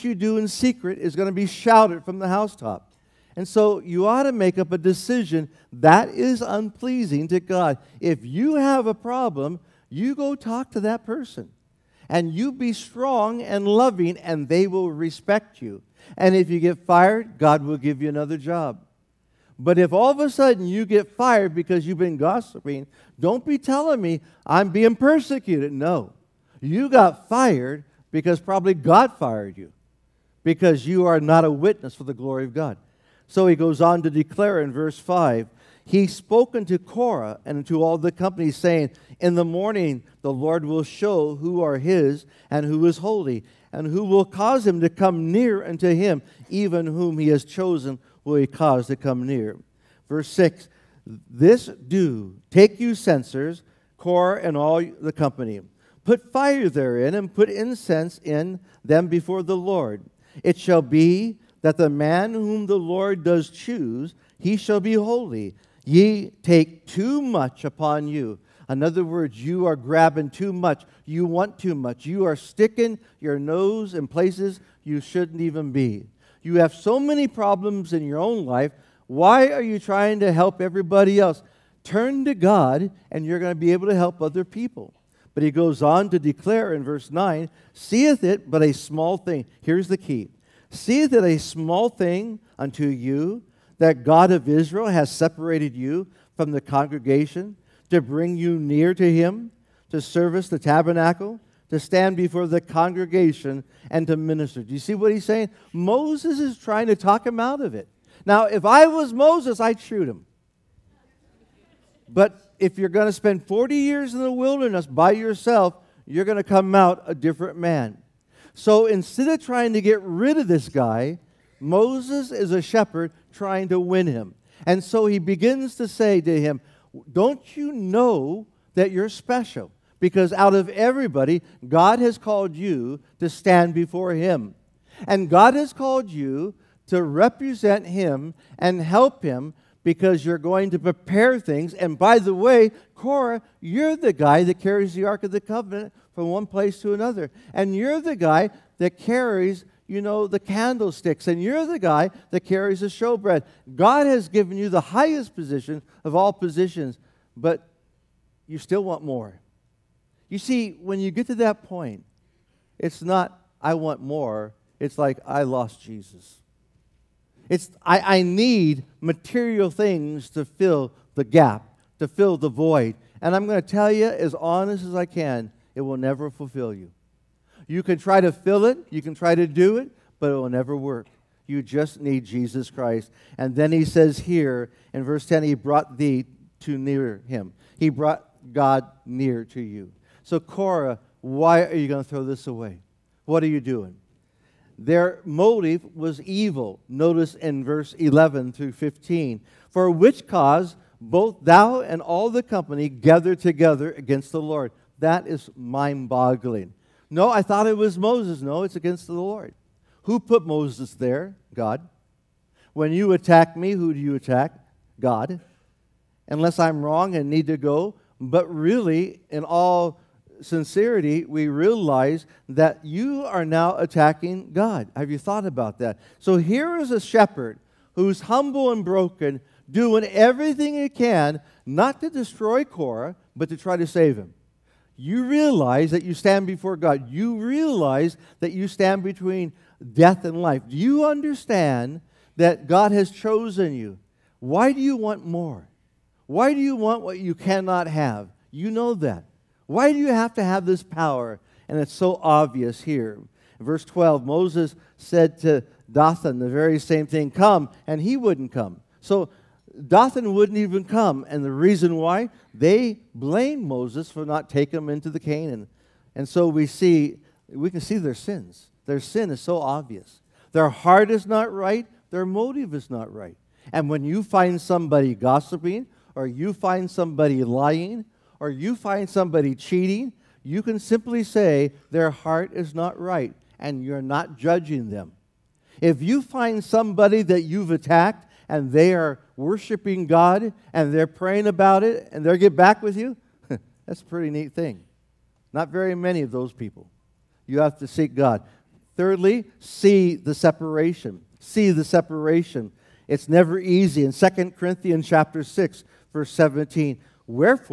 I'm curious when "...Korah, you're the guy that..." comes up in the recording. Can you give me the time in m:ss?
2:22.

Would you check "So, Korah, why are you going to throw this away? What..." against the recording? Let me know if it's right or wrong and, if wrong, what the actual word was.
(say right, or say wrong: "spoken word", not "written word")
right.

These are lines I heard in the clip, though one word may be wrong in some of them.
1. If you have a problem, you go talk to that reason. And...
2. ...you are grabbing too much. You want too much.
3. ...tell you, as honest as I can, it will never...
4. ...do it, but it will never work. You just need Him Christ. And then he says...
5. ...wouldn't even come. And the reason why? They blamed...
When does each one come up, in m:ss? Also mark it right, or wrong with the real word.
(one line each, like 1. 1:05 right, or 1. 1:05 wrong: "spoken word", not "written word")
1. 0:08 wrong: "person", not "reason"
2. 1:09 right
3. 2:53 right
4. 2:59 wrong: "Jesus", not "Him"
5. 4:20 right.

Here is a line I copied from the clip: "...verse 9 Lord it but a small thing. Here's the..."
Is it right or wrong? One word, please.
wrong.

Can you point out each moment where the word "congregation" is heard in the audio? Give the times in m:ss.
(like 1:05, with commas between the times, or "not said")
1:36, 1:42.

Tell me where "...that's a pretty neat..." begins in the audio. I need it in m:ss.
4:53.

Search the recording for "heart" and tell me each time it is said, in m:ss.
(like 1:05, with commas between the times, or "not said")
4:30, 4:42.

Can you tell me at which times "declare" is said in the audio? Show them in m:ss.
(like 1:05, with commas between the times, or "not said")
0:34, 1:26.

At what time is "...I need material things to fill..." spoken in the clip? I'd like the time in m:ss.
2:48.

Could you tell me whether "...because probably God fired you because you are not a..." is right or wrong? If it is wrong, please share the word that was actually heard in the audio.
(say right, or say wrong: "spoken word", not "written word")
right.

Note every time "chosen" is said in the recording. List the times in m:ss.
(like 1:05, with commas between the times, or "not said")
0:47, 4:03.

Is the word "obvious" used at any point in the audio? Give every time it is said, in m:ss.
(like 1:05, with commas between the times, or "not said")
4:12, 4:29.